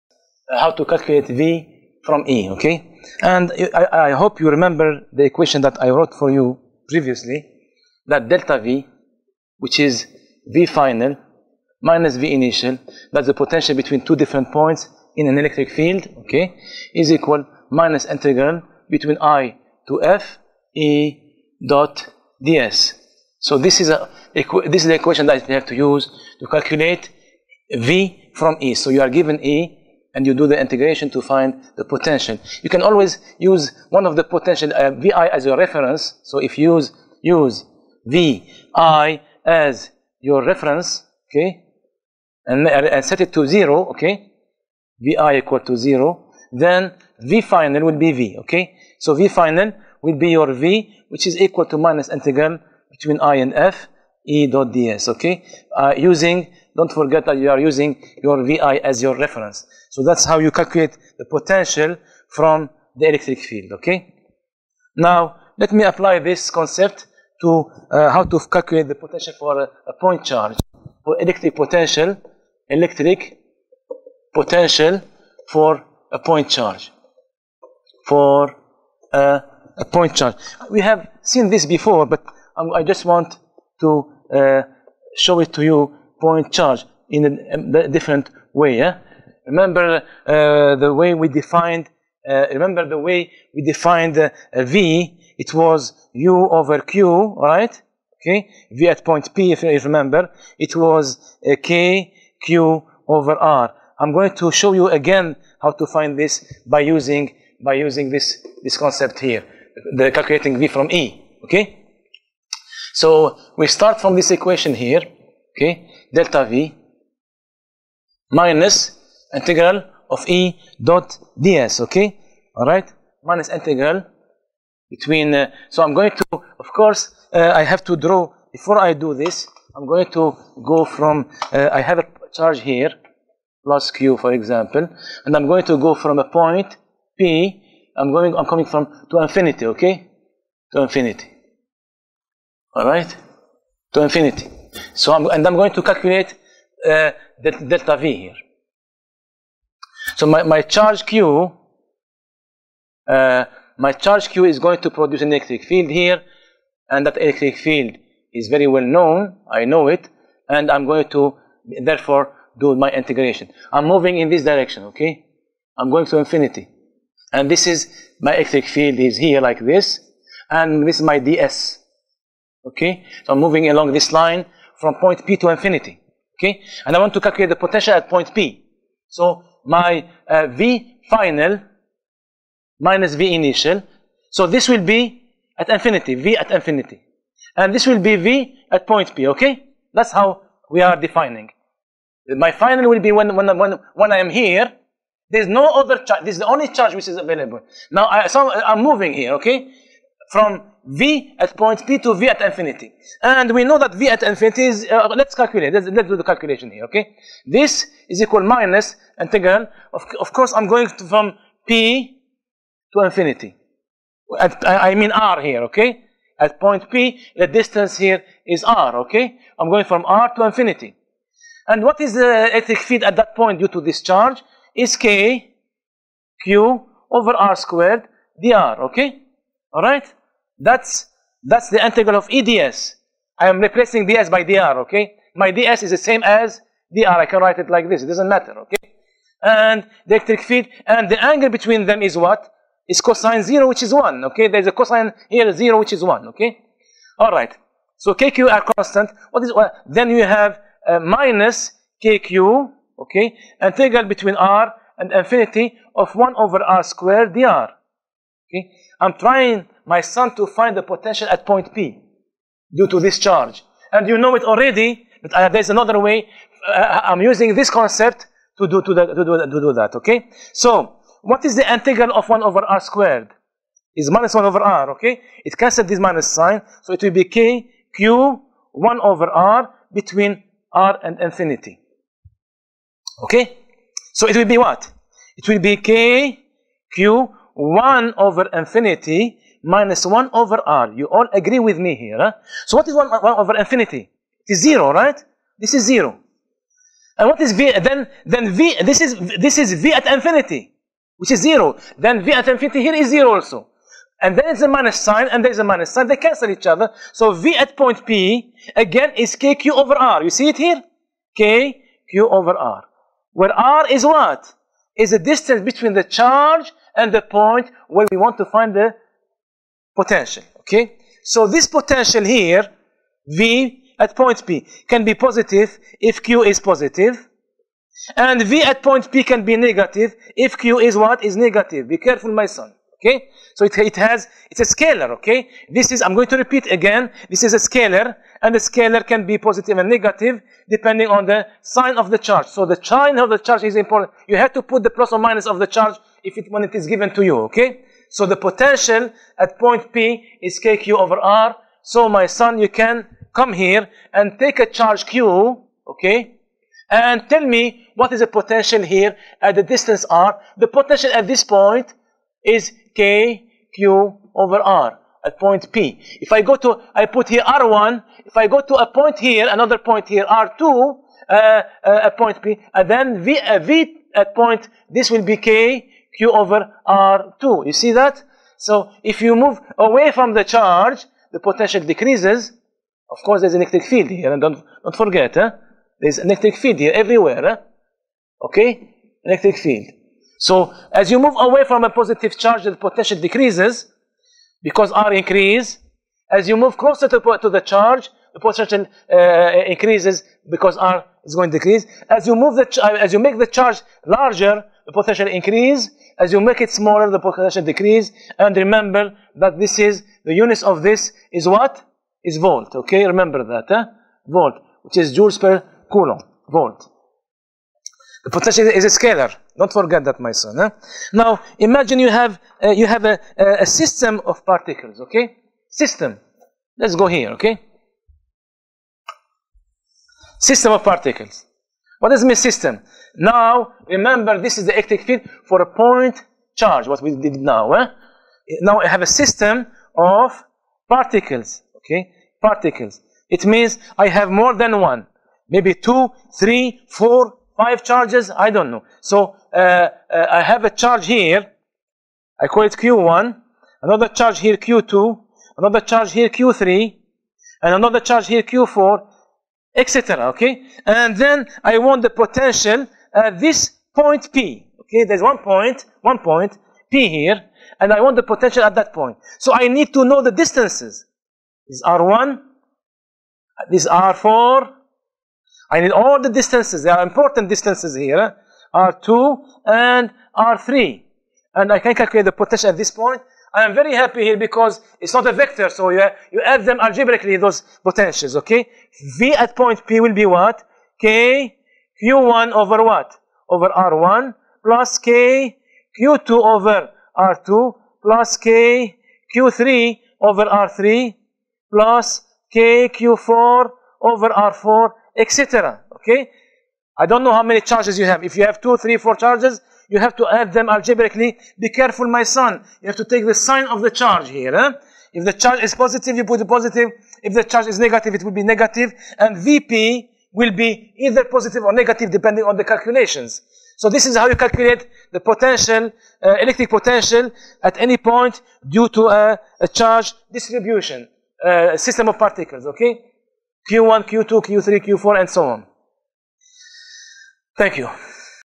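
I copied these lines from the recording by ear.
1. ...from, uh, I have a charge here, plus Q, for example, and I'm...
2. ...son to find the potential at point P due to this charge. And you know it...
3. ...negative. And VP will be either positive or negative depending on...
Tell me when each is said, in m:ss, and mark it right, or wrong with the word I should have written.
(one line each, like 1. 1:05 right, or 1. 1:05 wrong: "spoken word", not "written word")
1. 2:10 right
2. 4:20 right
3. 8:38 right.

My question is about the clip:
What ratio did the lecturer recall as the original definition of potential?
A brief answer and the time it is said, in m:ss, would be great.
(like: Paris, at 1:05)
U over Q, at 1:36.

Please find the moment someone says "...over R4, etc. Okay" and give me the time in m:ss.
8:24.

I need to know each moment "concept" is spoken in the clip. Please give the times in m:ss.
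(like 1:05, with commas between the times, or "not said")
1:06, 1:48, 4:27.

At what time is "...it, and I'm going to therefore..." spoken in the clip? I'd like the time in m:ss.
2:39.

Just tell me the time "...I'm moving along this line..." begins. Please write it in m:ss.
2:53.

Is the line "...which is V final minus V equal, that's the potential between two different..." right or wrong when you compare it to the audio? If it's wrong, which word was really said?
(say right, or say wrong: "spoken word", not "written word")
wrong: "initial", not "equal".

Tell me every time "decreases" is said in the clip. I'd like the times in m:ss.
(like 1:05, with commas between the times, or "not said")
6:21, 6:33, 6:41, 6:47.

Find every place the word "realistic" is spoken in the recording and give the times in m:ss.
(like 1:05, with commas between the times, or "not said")
not said.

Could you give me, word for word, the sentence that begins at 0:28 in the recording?
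So you are given E and you do the integration to find the potential.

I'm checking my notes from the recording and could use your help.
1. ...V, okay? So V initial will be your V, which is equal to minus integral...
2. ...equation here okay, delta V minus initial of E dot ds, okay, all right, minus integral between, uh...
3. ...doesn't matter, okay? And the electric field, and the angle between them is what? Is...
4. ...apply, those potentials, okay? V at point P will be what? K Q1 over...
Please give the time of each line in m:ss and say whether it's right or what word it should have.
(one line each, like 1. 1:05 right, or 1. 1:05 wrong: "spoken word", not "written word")
1. 0:48 wrong: "final", not "initial"
2. 1:54 wrong: "integral", not "initial"
3. 3:58 right
4. 8:06 wrong: "algebraically", not "apply".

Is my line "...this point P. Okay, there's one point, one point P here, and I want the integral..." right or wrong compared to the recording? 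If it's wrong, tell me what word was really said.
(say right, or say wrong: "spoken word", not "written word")
wrong: "potential", not "integral".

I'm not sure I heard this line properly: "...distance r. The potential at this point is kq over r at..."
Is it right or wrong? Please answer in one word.
right.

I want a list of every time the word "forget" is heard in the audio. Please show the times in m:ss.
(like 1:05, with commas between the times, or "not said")
0:56, 6:24, 6:59.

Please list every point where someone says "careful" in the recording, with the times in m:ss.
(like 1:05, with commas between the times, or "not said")
5:31, 8:31.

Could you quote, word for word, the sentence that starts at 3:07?
And this will be V at point P, okay?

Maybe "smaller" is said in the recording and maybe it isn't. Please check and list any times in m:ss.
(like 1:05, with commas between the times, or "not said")
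6:46.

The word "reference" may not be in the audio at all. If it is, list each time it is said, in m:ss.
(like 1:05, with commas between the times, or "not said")
0:35, 0:40, 0:59.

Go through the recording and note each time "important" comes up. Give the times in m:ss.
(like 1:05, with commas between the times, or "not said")
5:43, 7:57.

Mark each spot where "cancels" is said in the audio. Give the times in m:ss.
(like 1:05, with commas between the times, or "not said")
4:35, 5:06.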